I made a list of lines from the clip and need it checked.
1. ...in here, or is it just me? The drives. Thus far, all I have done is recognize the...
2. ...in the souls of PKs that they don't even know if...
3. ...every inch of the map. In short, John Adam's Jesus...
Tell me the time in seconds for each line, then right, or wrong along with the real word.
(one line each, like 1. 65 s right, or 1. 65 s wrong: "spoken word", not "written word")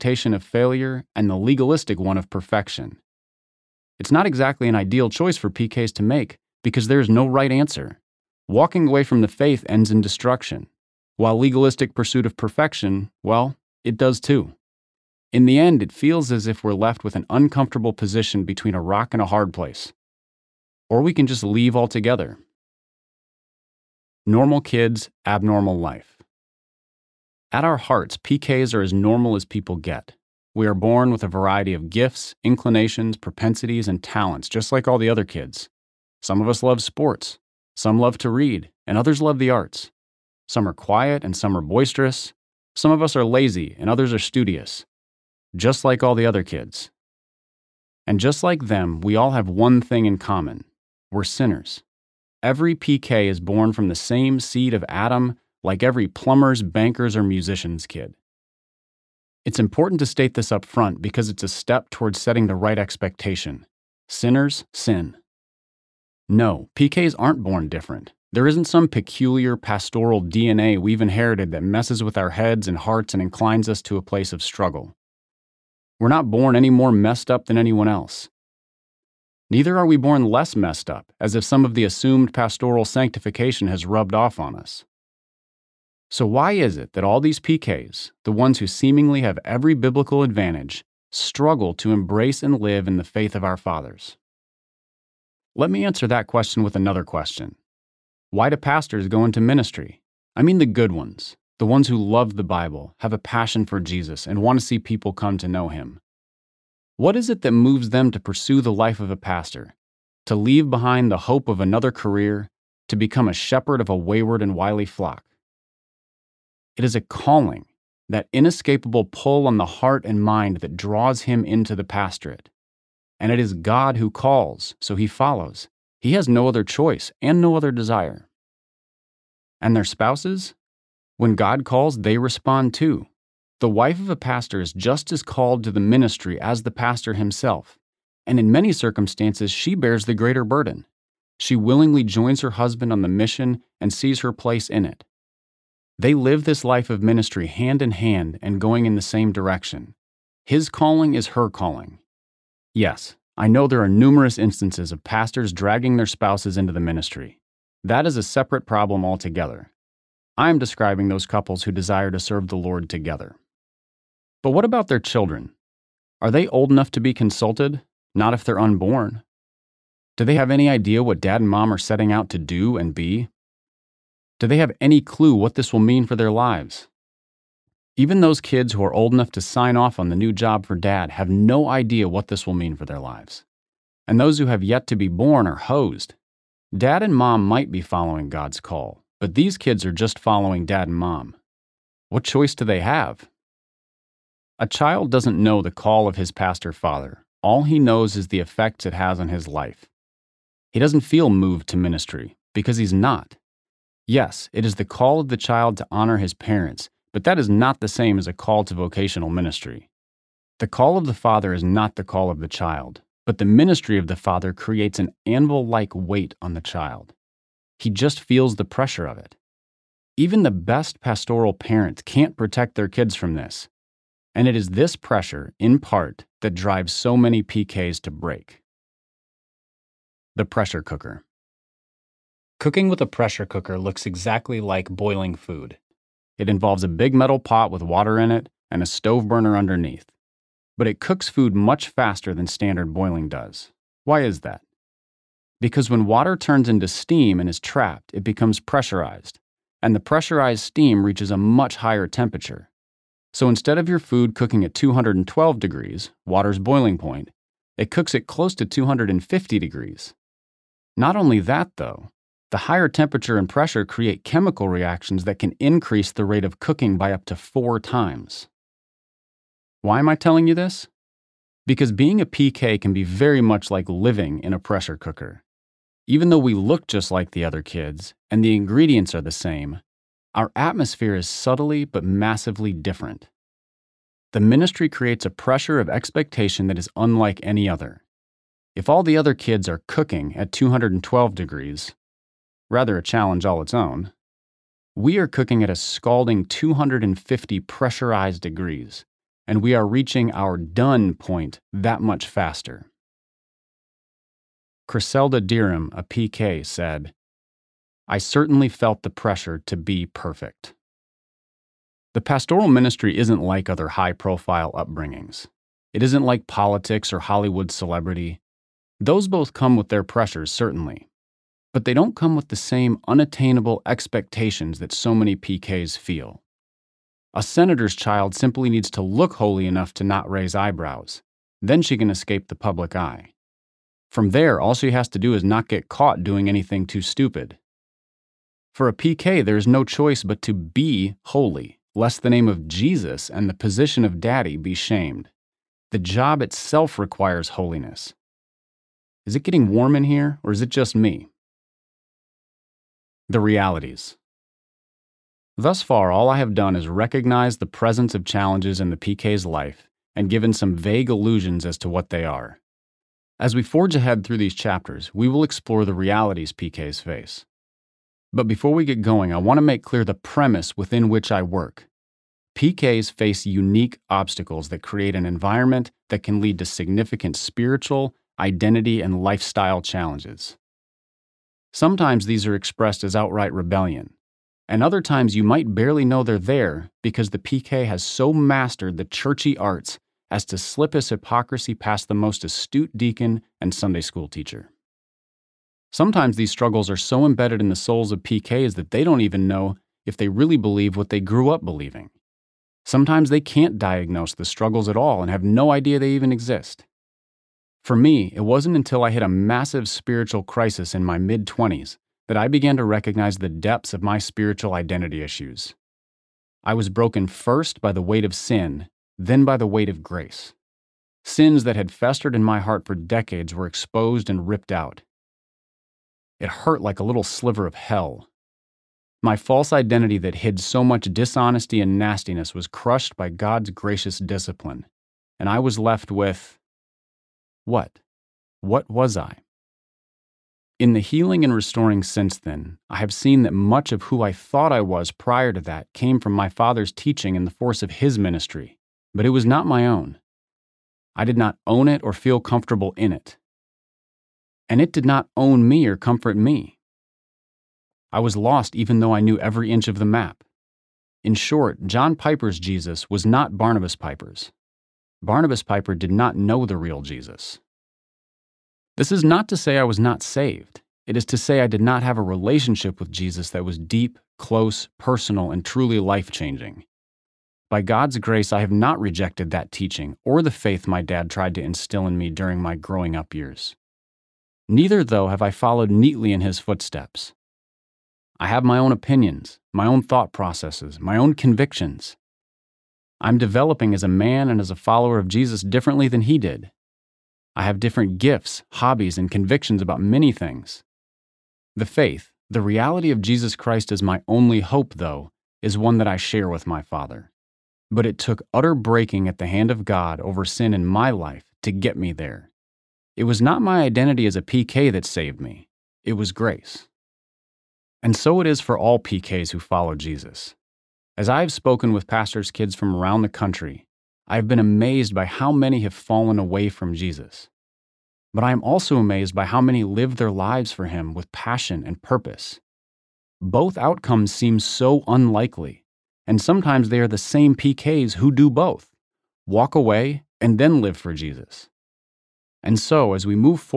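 1. 349 s wrong: "realities", not "drives"
2. 397 s right
3. 459 s wrong: "Piper", not "Adam".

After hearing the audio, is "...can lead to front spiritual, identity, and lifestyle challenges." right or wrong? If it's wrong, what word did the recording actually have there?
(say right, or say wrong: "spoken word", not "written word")
wrong: "significant", not "front".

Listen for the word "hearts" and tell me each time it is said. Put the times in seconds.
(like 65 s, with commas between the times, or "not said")
27 s, 72 s, 119 s, 422 s.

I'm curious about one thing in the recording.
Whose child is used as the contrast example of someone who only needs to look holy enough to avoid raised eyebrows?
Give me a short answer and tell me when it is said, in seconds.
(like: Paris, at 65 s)
A senator's, at 327 s.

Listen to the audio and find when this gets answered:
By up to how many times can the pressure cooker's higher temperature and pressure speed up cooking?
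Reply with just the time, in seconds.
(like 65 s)
267 s.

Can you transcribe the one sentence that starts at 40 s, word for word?
Some are quiet and some are boisterous.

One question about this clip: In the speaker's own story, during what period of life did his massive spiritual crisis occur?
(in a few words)
Mid 20s.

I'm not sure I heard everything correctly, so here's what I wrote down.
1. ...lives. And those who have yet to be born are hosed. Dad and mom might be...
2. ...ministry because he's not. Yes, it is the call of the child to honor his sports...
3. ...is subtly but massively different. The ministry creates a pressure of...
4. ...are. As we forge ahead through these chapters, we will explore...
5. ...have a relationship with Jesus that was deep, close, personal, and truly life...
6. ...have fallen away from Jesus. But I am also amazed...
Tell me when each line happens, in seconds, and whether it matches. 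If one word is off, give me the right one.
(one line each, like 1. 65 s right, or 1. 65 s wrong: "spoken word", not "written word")
1. 182 s right
2. 201 s wrong: "parents", not "sports"
3. 281 s right
4. 362 s right
5. 472 s right
6. 525 s right.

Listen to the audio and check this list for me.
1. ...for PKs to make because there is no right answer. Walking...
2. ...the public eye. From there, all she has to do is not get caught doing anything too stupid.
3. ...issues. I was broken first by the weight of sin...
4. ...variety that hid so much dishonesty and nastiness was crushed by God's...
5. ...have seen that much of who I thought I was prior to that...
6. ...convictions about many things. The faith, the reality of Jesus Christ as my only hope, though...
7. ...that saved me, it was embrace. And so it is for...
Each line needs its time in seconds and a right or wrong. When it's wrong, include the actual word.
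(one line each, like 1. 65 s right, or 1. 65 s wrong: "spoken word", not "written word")
1. 5 s right
2. 332 s right
3. 415 s right
4. 429 s wrong: "identity", not "variety"
5. 442 s right
6. 499 s right
7. 514 s wrong: "grace", not "embrace".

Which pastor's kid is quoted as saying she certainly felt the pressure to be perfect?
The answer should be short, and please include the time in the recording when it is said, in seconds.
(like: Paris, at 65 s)
Criselda Dirham, at 304 s.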